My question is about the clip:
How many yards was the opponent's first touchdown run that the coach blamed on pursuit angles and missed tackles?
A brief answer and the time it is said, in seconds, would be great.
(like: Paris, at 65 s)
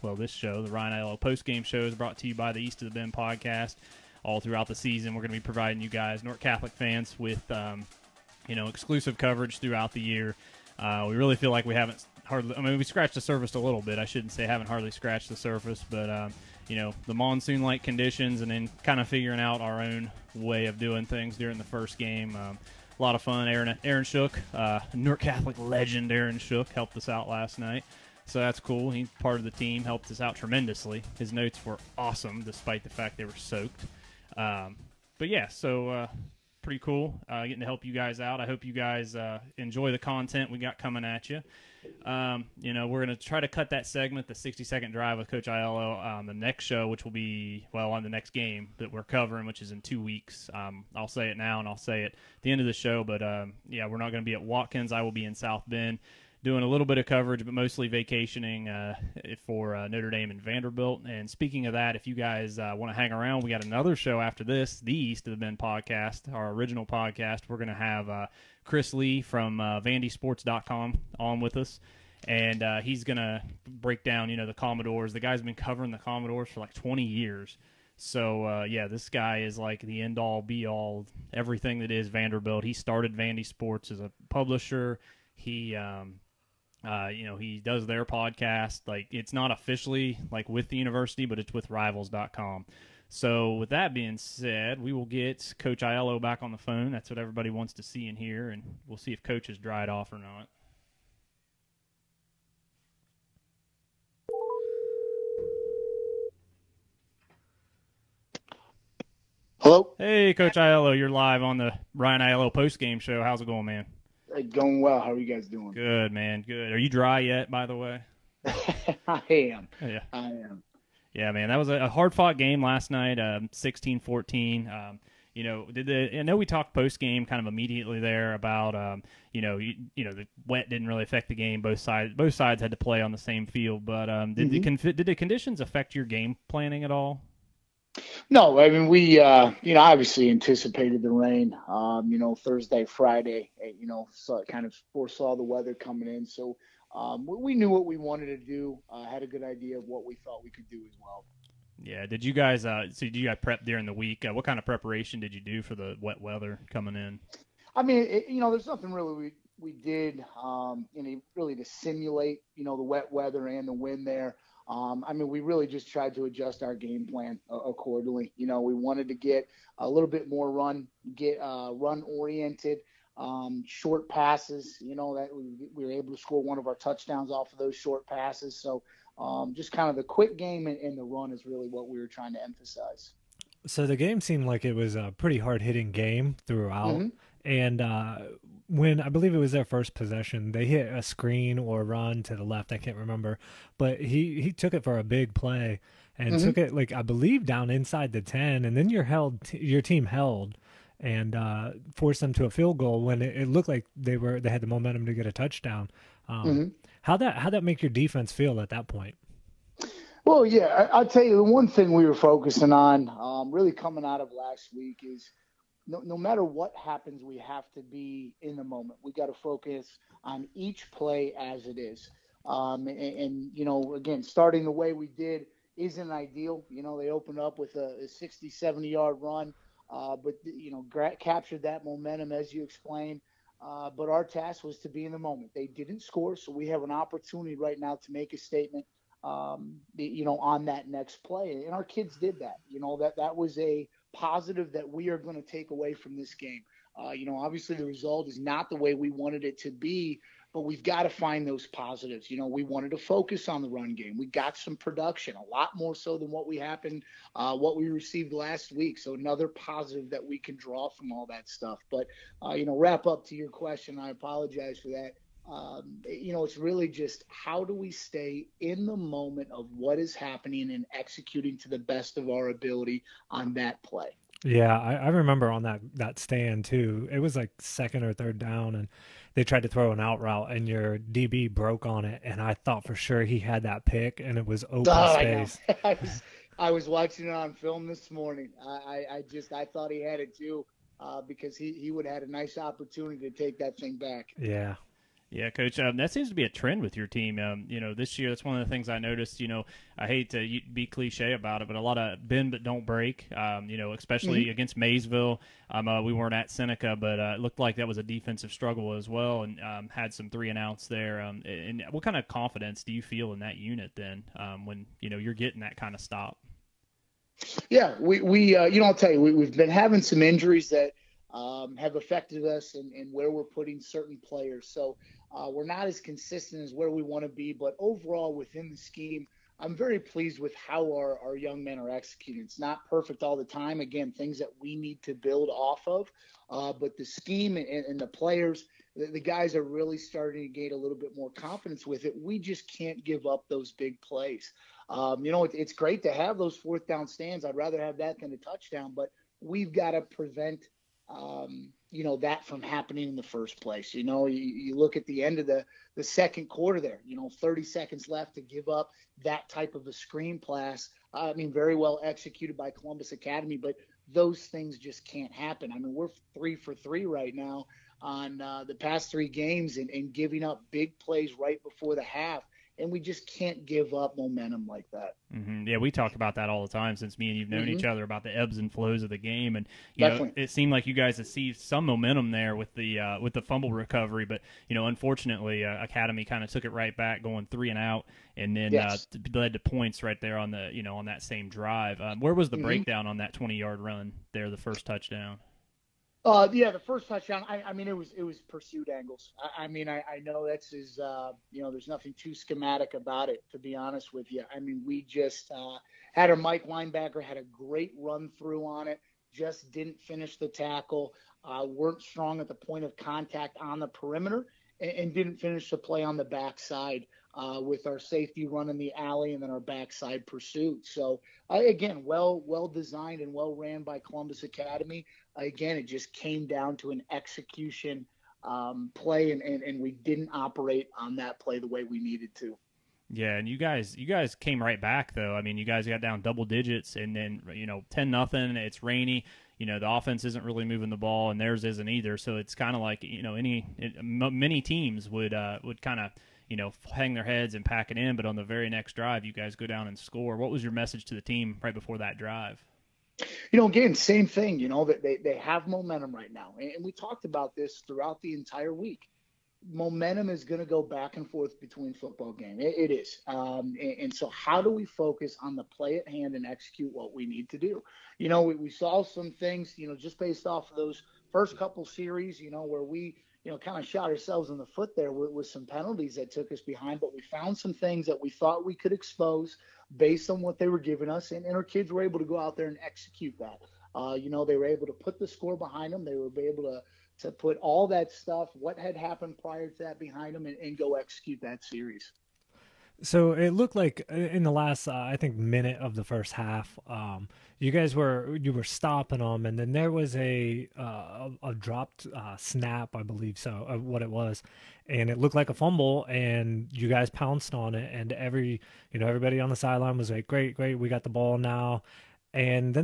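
20, at 393 s.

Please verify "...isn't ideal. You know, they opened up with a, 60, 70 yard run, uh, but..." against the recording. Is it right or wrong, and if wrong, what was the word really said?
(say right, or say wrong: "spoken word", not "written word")
right.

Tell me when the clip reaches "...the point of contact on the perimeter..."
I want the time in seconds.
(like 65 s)
412 s.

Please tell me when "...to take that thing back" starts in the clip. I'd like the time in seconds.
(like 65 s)
293 s.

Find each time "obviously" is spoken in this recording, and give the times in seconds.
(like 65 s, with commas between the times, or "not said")
139 s, 247 s.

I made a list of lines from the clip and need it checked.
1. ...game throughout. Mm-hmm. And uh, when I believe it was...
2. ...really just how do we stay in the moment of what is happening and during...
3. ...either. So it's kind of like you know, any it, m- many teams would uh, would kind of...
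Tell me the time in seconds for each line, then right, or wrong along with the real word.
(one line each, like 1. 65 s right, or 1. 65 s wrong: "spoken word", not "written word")
1. 185 s right
2. 266 s wrong: "executing", not "during"
3. 441 s right.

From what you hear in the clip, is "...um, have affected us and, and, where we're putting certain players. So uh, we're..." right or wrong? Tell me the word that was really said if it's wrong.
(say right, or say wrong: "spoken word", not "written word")
right.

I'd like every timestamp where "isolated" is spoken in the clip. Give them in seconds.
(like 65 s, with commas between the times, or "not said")
not said.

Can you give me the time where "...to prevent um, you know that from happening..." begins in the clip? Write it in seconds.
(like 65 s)
349 s.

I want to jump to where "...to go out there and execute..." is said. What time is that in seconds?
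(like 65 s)
482 s.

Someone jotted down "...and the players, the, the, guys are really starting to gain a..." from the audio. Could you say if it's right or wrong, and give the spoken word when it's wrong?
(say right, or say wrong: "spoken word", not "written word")
right.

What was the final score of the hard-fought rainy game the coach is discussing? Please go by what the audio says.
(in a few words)
16-14.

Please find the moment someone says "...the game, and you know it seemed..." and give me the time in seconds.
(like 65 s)
379 s.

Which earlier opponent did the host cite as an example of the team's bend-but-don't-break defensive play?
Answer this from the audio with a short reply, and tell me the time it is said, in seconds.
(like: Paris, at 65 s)
Maysville, at 304 s.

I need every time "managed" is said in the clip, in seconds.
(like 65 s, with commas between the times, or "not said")
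not said.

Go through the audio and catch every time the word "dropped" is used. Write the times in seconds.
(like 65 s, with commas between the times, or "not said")
501 s.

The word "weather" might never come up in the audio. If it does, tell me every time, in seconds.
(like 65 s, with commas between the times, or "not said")
145 s, 156 s, 163 s.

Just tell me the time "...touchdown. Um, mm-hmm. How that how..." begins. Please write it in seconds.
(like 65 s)
205 s.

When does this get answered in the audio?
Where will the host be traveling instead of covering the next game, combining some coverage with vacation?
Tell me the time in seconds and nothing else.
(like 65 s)
55 s.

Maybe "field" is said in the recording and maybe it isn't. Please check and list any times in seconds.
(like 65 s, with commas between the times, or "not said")
133 s, 202 s.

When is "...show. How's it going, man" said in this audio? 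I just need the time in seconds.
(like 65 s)
112 s.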